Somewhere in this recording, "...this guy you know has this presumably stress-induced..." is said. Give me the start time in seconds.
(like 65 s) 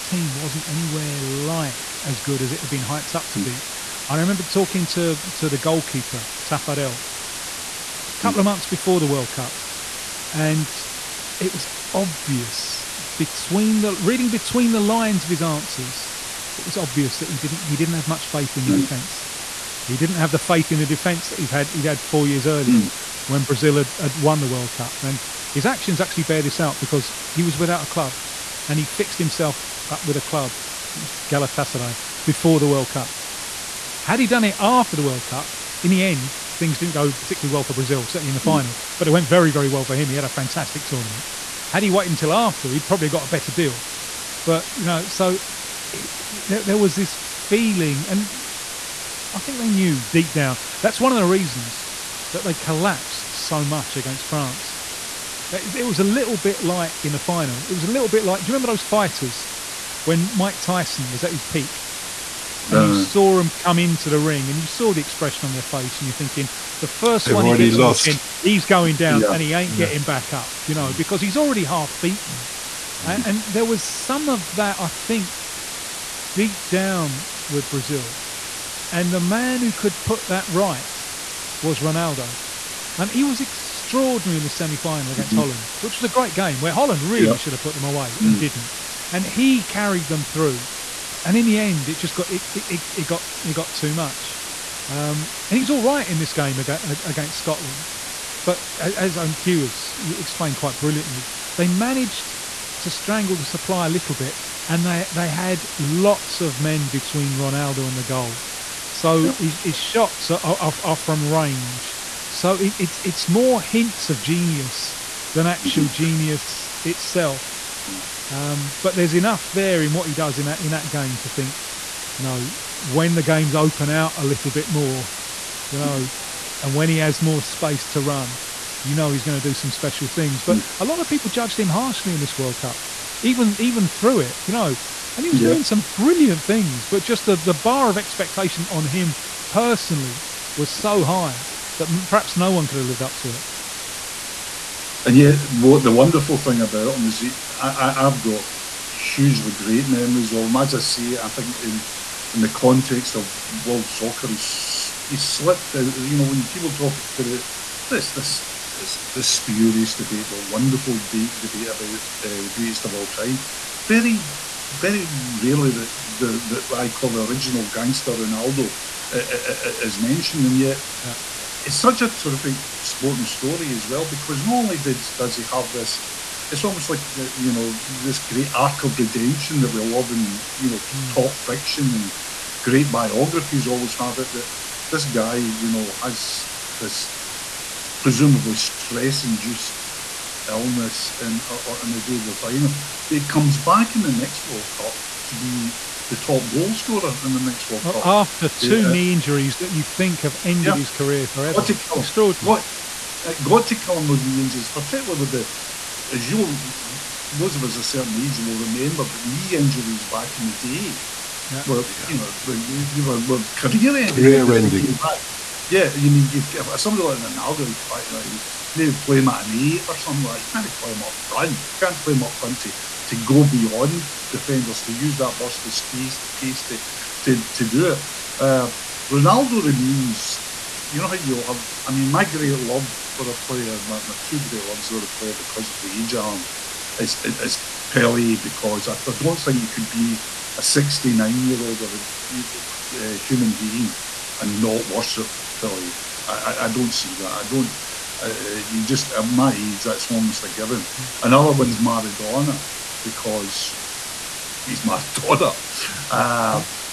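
184 s.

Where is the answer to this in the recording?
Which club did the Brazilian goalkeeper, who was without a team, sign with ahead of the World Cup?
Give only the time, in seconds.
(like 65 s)
31 s.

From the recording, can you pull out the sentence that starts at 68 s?
he's going down yeah, and he ain't yeah.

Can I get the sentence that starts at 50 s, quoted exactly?
That's one of the reasons that they collapsed so much against France.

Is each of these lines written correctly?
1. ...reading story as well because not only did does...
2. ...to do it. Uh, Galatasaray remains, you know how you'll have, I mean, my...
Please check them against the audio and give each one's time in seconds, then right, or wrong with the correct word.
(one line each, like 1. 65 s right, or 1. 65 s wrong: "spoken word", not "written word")
1. 172 s wrong: "sporting", not "reading"
2. 227 s wrong: "Ronaldo", not "Galatasaray".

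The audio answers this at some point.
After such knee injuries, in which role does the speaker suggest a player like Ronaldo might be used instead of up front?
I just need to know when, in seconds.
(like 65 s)
219 s.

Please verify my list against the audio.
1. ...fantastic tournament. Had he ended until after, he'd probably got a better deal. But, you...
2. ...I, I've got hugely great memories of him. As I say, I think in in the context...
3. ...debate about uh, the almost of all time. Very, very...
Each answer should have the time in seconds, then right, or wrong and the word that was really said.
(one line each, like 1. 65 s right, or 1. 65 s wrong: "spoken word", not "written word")
1. 40 s wrong: "waited", not "ended"
2. 147 s right
3. 161 s wrong: "greatest", not "almost".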